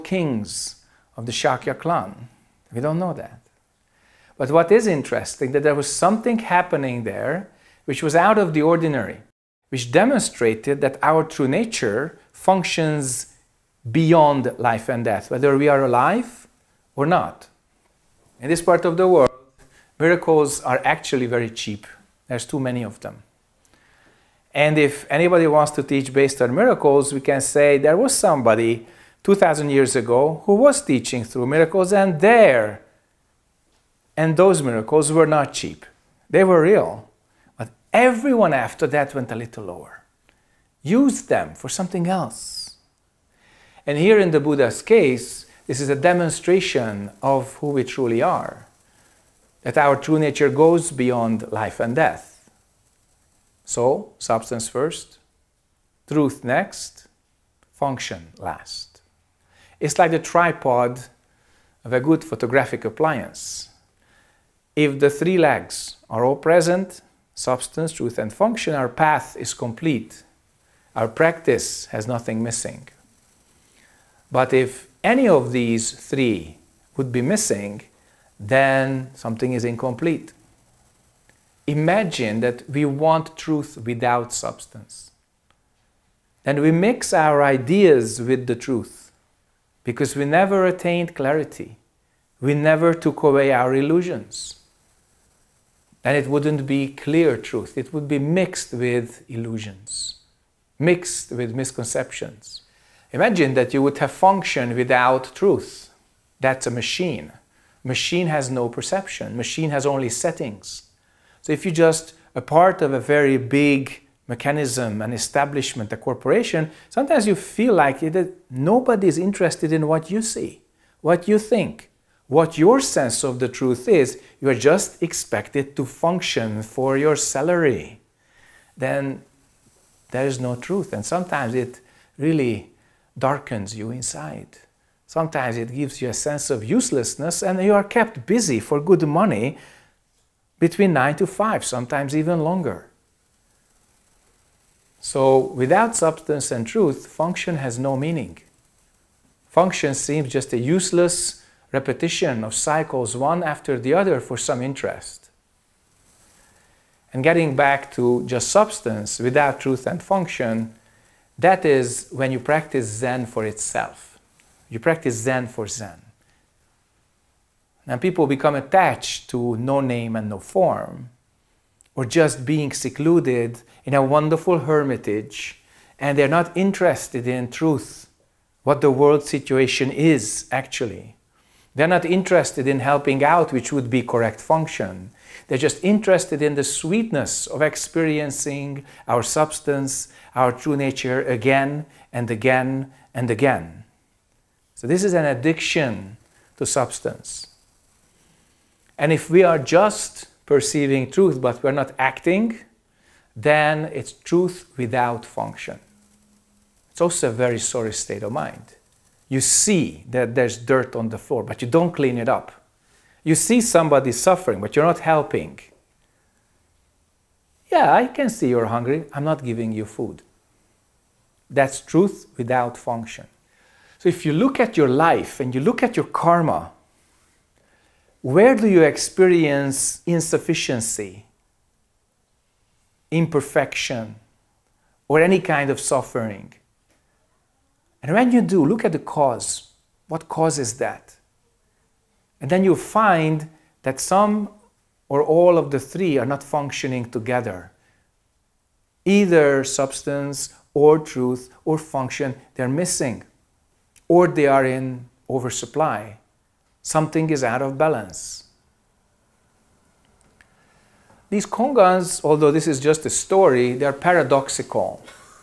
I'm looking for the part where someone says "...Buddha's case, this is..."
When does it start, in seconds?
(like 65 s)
44 s.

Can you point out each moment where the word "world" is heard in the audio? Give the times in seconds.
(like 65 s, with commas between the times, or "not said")
19 s, 178 s.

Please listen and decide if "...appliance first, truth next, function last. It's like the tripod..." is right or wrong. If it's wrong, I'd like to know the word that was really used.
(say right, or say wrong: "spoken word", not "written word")
wrong: "substance", not "appliance".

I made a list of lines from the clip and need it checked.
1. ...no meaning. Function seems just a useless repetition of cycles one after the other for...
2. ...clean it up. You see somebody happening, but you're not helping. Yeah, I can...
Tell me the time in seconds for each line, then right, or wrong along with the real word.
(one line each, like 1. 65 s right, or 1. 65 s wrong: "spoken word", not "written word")
1. 147 s right
2. 211 s wrong: "suffering", not "happening".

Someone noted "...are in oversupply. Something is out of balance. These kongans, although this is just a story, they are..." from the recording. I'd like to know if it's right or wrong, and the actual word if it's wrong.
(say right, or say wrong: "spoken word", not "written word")
right.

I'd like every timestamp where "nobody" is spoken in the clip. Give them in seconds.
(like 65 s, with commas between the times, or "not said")
118 s.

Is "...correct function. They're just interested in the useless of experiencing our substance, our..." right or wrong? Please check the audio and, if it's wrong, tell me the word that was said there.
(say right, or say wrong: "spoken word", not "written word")
wrong: "sweetness", not "useless".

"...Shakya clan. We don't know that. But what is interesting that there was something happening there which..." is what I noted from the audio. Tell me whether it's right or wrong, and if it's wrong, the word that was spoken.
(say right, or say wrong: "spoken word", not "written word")
right.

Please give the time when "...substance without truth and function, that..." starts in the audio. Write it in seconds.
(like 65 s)
158 s.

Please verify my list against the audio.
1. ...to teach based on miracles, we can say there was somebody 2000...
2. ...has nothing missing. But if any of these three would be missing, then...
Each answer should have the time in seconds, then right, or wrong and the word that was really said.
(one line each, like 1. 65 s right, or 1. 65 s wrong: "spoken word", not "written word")
1. 25 s right
2. 71 s right.